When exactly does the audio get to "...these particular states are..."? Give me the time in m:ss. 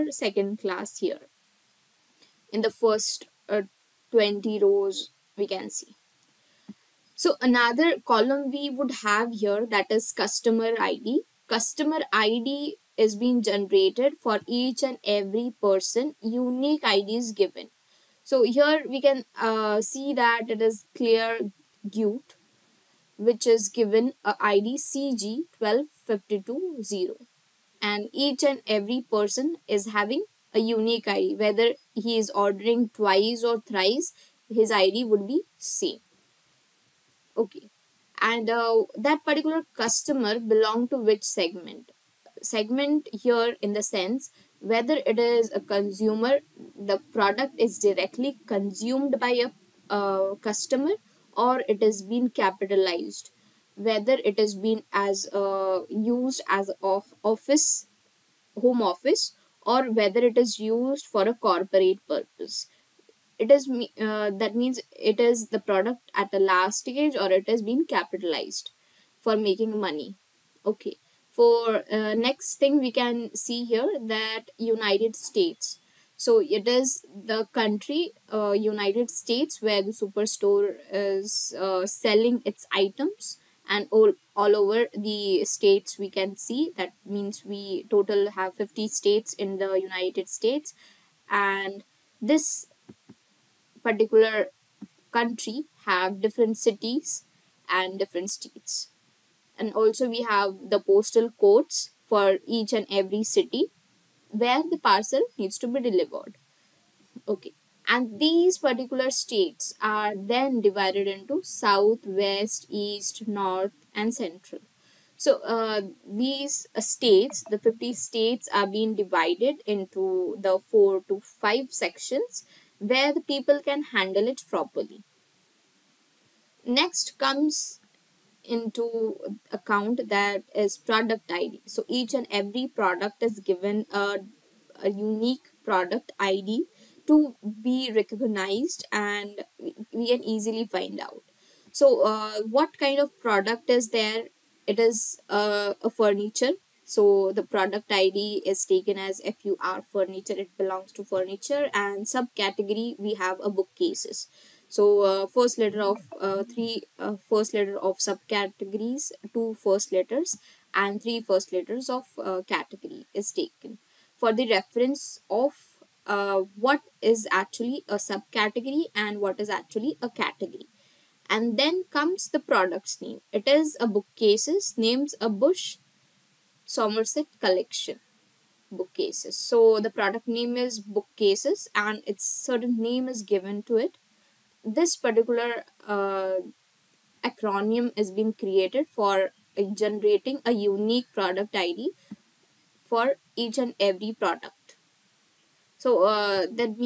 1:48.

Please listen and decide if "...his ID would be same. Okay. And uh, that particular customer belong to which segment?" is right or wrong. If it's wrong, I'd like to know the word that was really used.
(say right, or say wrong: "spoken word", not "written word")
right.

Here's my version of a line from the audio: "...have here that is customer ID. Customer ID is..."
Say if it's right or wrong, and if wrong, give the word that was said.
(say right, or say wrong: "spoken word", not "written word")
right.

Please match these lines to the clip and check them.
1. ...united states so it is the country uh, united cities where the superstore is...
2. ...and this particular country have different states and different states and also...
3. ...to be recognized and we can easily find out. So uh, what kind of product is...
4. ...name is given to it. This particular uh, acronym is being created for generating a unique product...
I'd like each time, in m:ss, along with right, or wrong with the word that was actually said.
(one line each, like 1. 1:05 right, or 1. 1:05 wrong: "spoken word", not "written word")
1. 1:14 wrong: "states", not "cities"
2. 1:31 wrong: "cities", not "states"
3. 2:17 right
4. 3:02 right.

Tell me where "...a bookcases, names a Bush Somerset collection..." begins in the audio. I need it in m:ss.
2:53.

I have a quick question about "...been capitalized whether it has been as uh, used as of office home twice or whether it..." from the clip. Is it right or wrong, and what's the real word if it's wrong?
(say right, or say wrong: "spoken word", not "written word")
wrong: "office", not "twice".